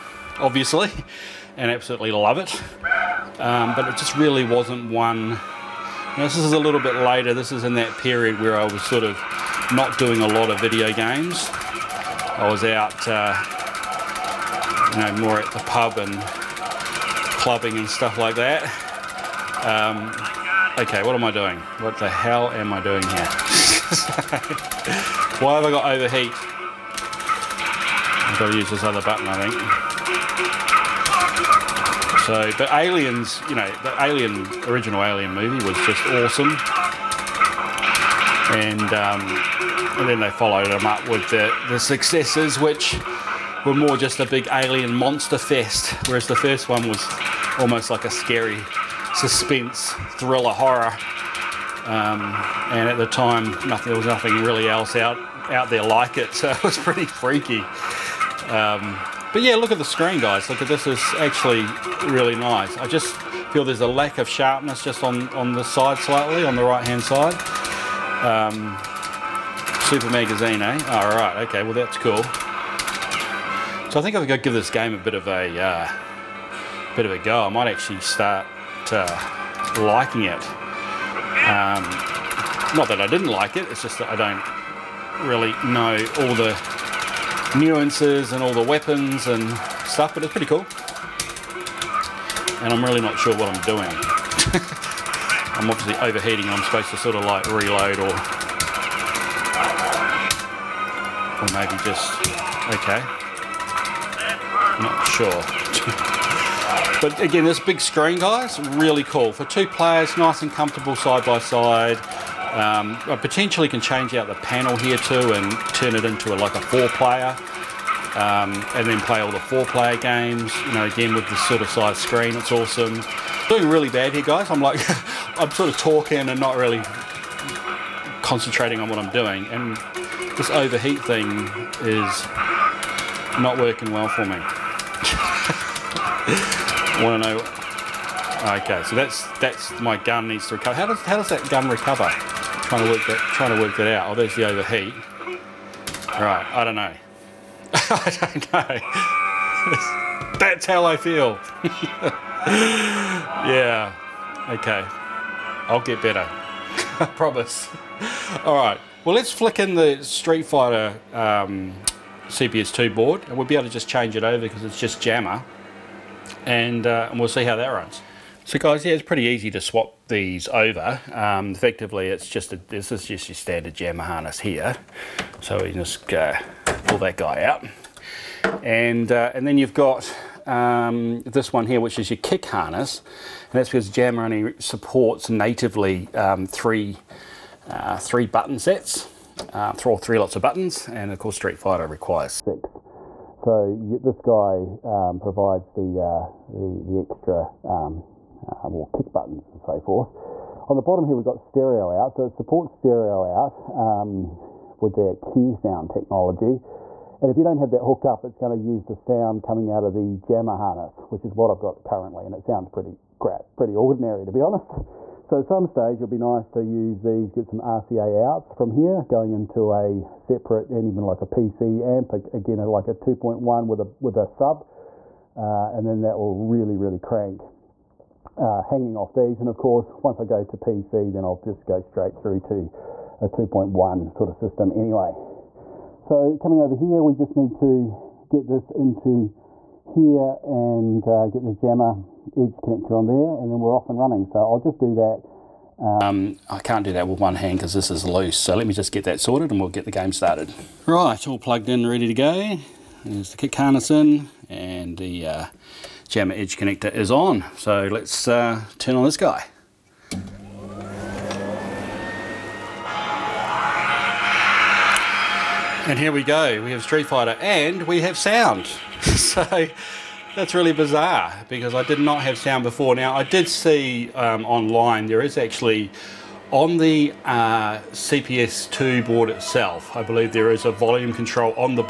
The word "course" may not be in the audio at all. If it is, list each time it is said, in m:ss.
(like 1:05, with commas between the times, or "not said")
3:11, 3:49.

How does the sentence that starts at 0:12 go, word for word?
I was out, uh, you know, more at the pub and clubbing and stuff like that.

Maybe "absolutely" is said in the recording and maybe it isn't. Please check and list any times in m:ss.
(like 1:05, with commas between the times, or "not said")
0:01.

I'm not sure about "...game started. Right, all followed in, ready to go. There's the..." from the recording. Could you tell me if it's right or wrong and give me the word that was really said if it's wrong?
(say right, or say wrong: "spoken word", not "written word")
wrong: "plugged", not "followed".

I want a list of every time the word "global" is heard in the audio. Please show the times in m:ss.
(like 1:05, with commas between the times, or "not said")
not said.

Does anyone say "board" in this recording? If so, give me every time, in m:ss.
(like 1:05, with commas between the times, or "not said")
2:42, 4:39.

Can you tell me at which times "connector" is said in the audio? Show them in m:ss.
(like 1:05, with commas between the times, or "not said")
4:02, 4:16.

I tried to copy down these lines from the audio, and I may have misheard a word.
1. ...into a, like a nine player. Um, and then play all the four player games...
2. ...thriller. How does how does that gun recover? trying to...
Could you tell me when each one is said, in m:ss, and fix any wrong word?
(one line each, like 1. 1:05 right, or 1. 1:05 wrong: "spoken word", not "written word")
1. 1:56 wrong: "four", not "nine"
2. 2:20 wrong: "recover", not "thriller".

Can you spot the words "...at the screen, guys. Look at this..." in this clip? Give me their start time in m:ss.
0:59.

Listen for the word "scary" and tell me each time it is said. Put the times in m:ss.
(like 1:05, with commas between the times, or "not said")
0:48.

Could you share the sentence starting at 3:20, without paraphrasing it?
On the bottom here, we've got stereo out, so it supports stereo out um, with their QSound technology.